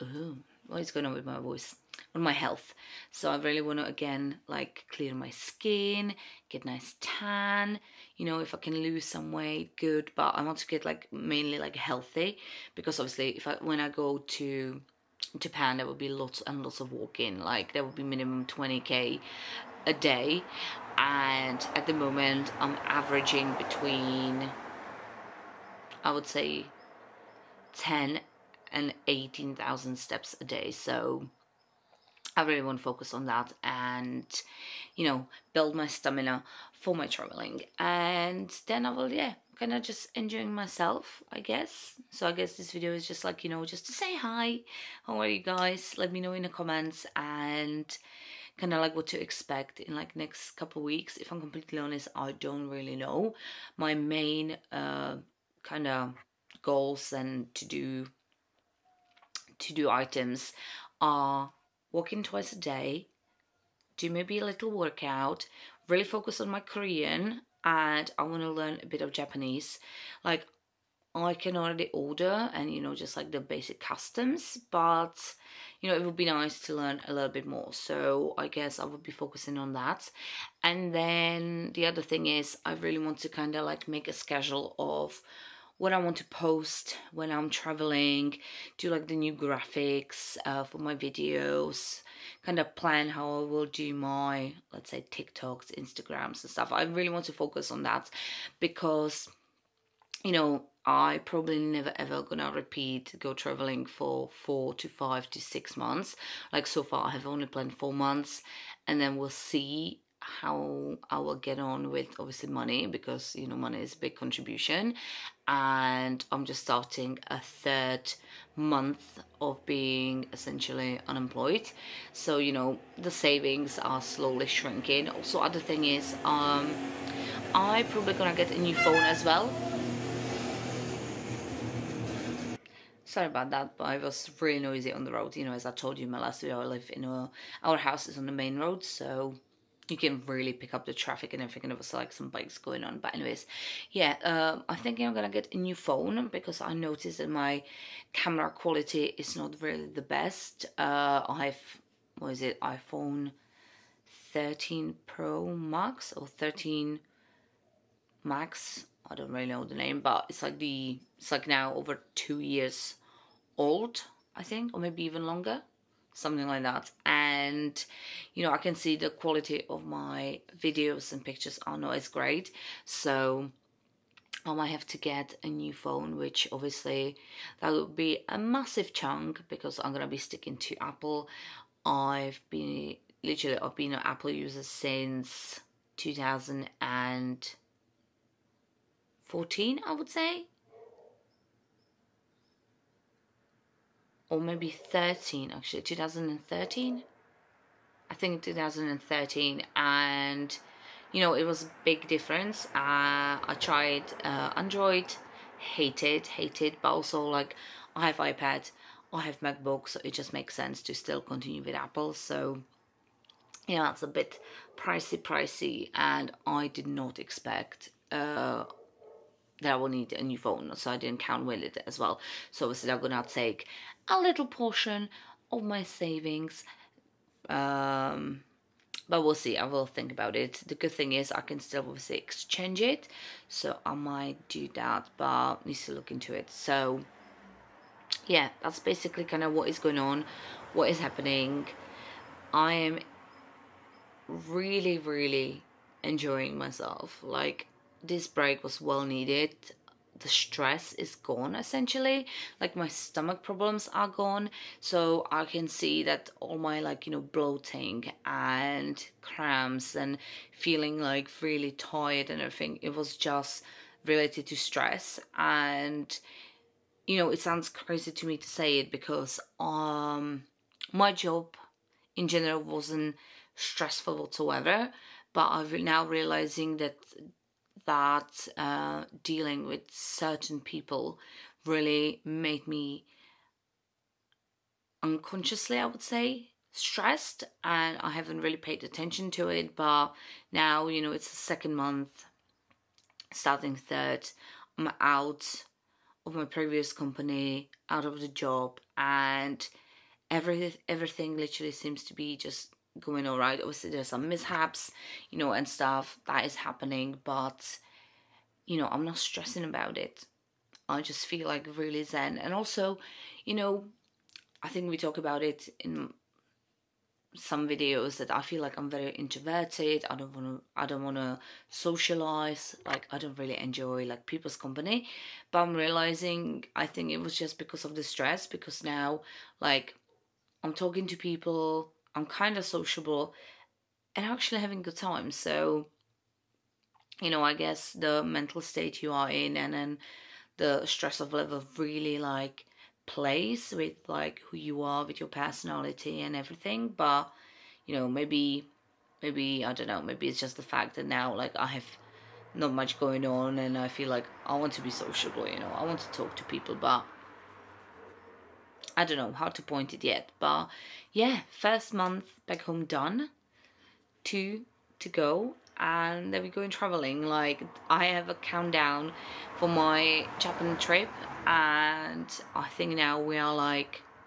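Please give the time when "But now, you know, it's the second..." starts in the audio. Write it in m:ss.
4:49.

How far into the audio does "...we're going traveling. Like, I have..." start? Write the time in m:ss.
6:06.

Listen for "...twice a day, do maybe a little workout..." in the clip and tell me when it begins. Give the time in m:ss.
1:02.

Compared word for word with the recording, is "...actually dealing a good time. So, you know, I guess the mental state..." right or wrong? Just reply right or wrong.
wrong.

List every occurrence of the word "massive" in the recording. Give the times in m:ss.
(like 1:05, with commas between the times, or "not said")
2:58.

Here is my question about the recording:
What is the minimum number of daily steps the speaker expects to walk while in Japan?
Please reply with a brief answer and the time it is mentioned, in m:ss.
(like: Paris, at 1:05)
20k, at 0:18.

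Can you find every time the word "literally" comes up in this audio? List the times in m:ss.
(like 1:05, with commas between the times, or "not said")
3:03, 5:01.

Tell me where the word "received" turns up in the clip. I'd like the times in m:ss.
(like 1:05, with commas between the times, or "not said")
not said.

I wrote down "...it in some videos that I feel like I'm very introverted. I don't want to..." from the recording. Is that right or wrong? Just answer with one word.
right.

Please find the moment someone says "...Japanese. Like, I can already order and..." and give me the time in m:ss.
1:09.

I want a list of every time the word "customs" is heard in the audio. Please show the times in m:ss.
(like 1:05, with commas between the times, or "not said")
1:13.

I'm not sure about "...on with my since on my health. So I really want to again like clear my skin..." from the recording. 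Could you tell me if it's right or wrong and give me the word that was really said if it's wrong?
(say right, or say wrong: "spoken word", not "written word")
wrong: "voice", not "since".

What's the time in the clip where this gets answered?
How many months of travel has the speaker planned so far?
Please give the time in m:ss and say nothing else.
1:47.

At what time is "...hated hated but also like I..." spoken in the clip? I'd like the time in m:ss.
3:25.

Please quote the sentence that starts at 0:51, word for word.
If I'm completely honest, I don't really know.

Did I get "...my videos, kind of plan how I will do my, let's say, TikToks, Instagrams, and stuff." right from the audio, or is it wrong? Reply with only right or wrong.
right.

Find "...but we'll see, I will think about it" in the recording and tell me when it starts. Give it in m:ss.
3:49.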